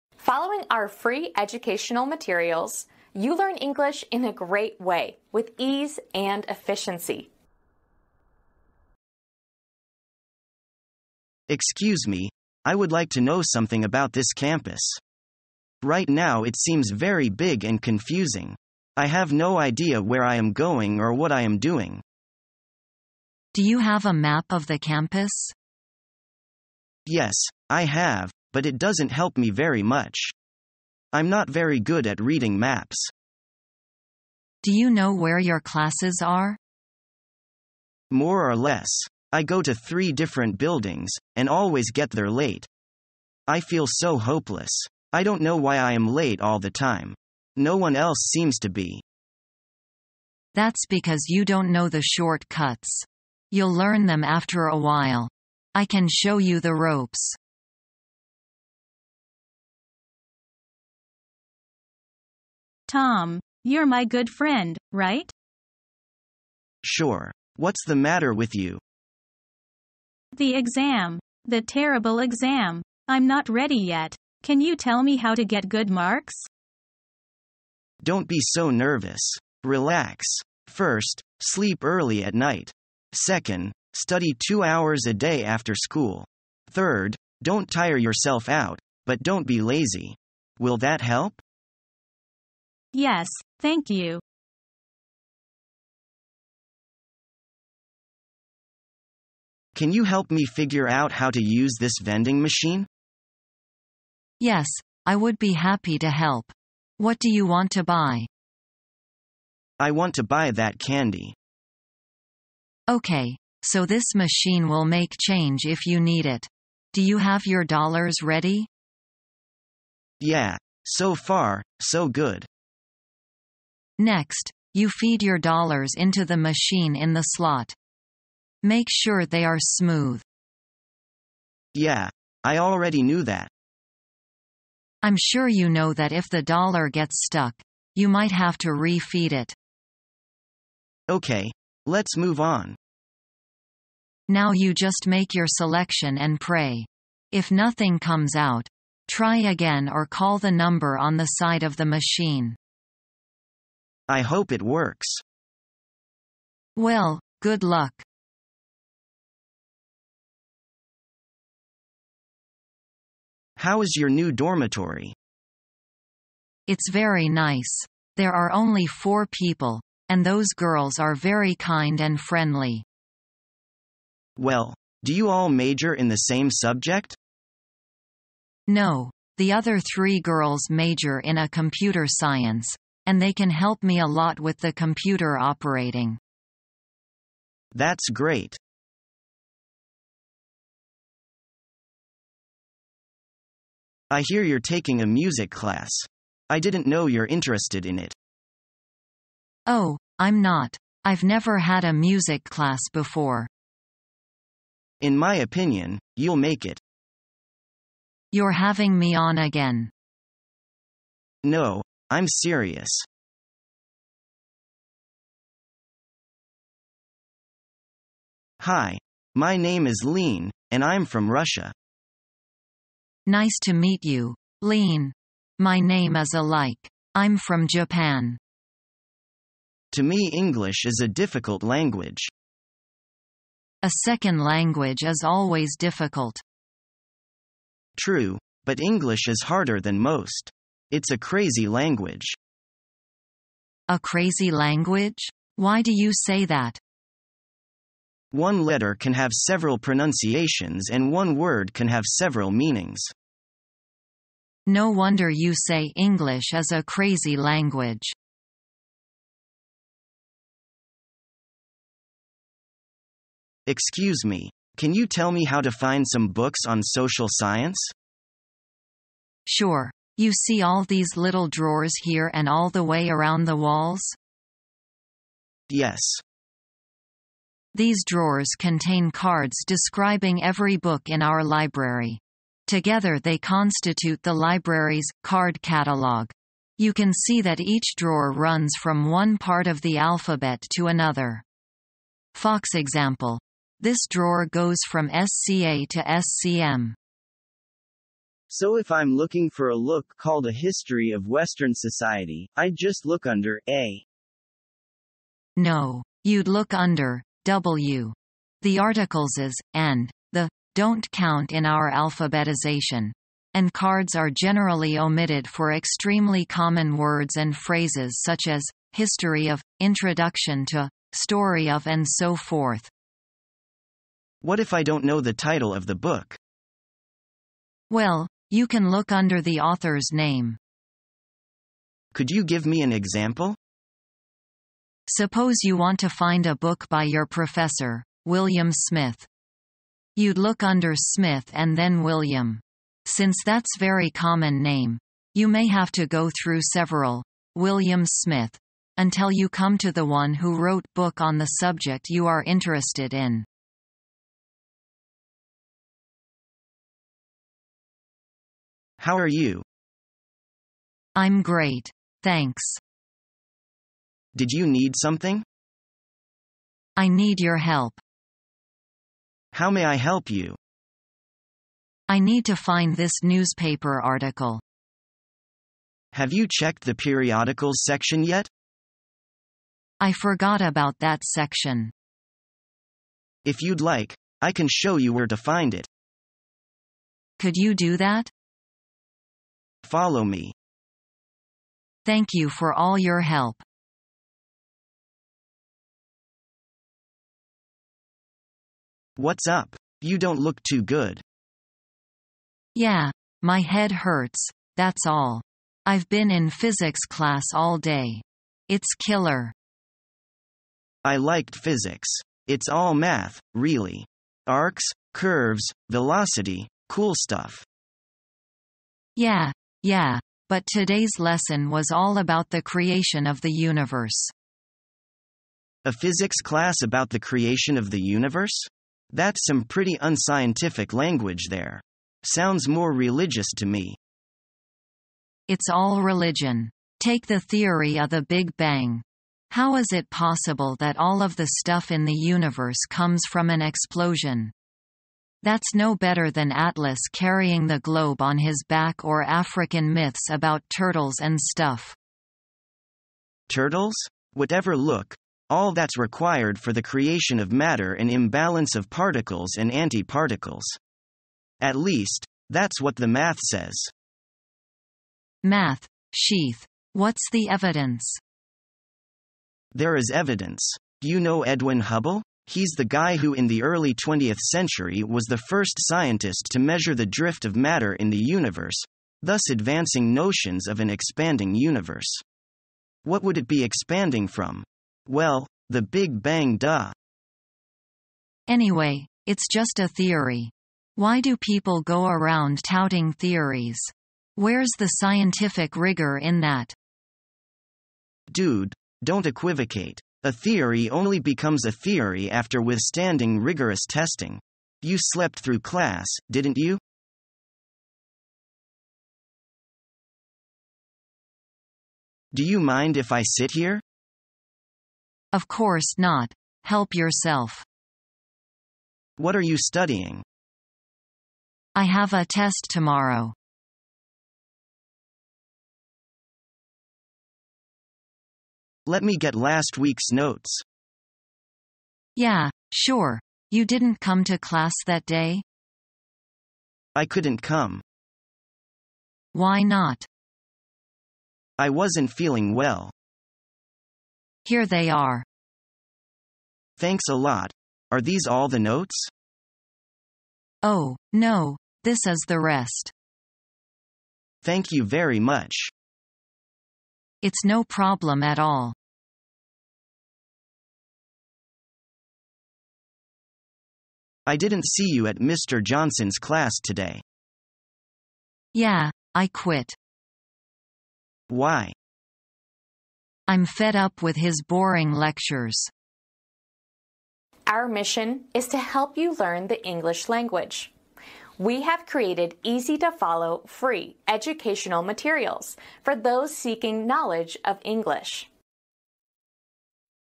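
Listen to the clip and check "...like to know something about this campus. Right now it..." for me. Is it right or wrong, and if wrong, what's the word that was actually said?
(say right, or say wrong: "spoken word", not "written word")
right.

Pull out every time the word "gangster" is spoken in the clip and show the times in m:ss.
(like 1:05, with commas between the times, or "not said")
not said.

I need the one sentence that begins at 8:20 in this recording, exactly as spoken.
A theory only becomes a theory after withstanding rigorous testing.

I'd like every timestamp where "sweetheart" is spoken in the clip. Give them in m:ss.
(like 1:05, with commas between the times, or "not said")
not said.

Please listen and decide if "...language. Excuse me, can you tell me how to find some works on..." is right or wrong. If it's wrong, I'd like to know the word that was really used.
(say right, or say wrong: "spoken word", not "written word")
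wrong: "books", not "works".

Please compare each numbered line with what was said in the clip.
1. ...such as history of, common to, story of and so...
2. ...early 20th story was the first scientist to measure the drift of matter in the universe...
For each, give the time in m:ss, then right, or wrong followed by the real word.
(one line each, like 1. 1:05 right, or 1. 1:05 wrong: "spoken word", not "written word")
1. 5:18 wrong: "introduction", not "common"
2. 7:53 wrong: "century", not "story".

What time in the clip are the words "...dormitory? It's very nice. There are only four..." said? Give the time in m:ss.
2:44.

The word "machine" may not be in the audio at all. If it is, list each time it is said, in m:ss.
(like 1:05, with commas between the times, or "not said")
1:42, 1:54, 2:06, 2:31.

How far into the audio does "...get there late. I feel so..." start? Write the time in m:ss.
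0:41.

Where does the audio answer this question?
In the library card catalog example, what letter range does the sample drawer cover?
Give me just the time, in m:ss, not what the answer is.
4:55.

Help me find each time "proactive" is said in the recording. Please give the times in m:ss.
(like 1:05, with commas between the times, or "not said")
not said.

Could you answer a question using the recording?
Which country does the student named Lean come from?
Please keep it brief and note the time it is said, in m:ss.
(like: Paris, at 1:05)
Russia, at 3:41.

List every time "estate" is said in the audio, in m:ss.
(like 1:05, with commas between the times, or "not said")
not said.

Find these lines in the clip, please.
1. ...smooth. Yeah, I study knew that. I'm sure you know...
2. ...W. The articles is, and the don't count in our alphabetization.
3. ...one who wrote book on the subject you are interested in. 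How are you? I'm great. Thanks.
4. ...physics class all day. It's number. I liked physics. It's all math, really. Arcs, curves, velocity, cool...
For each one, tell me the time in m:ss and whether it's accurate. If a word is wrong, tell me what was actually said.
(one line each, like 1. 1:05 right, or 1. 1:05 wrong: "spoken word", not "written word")
1. 2:09 wrong: "already", not "study"
2. 5:07 right
3. 5:50 right
4. 6:46 wrong: "killer", not "number".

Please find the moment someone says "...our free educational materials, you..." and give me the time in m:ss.
0:00.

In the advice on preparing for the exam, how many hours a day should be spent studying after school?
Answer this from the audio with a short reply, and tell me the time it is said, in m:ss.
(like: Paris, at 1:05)
2, at 1:24.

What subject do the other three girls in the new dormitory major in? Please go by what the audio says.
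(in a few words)
Computer science.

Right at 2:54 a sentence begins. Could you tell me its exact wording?
Well, do you all major in the same subject?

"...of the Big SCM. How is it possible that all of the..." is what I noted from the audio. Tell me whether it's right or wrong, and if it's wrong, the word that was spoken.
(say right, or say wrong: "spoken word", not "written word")
wrong: "Bang", not "SCM".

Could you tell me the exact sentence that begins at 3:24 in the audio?
In my opinion, you'll make it.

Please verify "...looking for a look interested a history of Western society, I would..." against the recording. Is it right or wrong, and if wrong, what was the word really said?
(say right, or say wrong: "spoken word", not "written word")
wrong: "called", not "interested".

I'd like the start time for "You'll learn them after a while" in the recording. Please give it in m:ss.
0:53.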